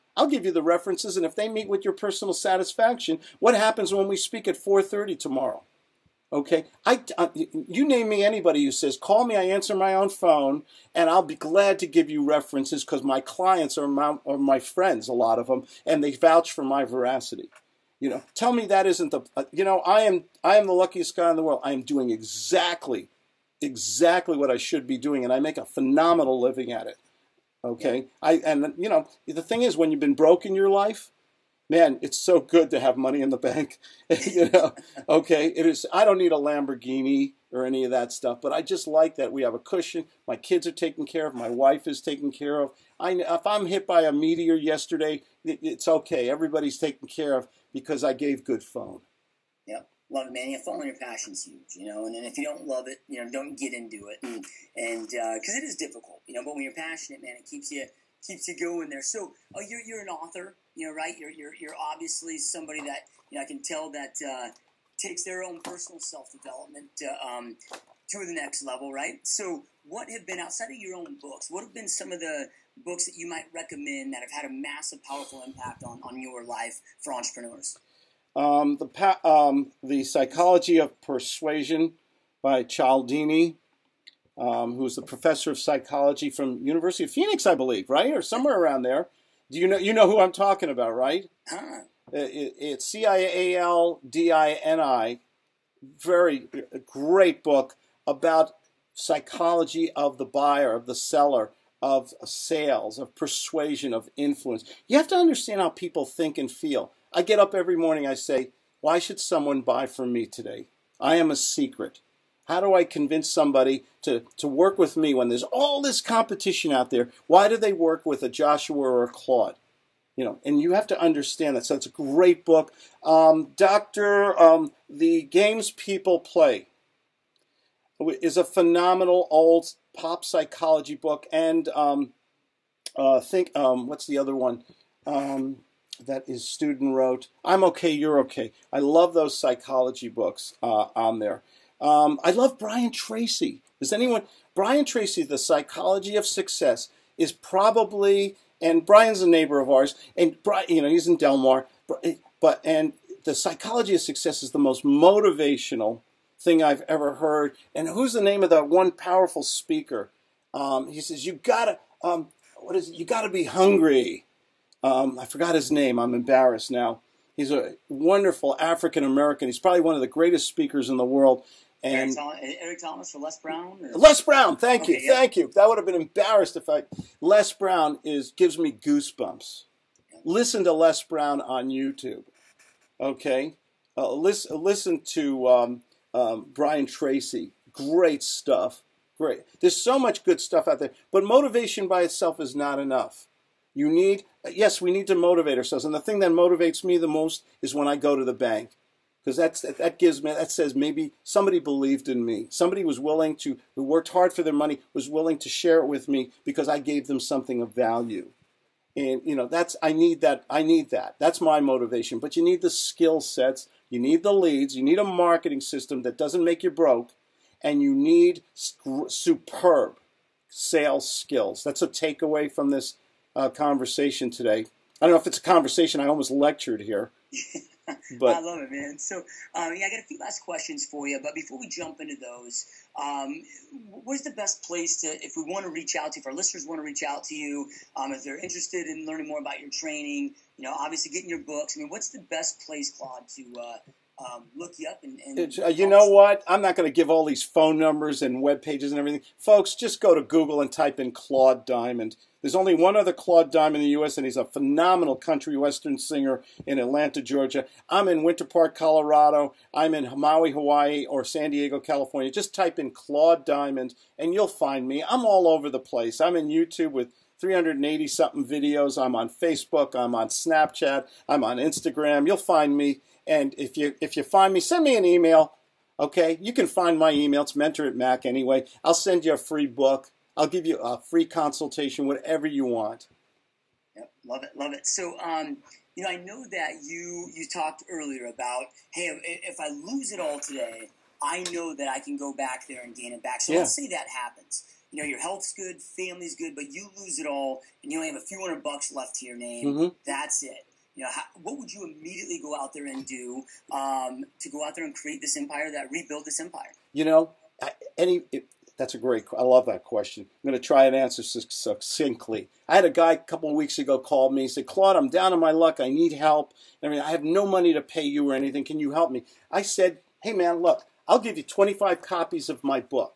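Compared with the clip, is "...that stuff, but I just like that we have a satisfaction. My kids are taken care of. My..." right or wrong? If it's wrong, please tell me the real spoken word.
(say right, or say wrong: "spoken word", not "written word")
wrong: "cushion", not "satisfaction".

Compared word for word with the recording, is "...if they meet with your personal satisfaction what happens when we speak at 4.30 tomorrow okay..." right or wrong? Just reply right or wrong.
right.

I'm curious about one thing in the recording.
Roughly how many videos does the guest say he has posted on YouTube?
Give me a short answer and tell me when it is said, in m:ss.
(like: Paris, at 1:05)
380, at 4:27.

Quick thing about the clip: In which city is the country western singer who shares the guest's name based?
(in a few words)
Atlanta.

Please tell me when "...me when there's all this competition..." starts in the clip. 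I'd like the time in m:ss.
1:54.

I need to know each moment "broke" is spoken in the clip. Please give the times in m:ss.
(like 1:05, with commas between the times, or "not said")
0:30, 3:36.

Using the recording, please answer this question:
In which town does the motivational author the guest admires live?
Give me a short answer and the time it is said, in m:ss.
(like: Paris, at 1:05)
Del Mar, at 2:31.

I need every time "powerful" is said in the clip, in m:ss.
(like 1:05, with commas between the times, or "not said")
1:15, 2:38.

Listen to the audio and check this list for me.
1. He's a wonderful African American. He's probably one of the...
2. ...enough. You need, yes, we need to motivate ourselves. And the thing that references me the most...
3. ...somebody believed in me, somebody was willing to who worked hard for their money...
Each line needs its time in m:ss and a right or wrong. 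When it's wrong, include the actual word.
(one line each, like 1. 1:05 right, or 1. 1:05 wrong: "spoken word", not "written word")
1. 2:47 right
2. 3:12 wrong: "motivates", not "references"
3. 3:21 right.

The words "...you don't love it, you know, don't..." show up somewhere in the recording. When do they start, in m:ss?
0:52.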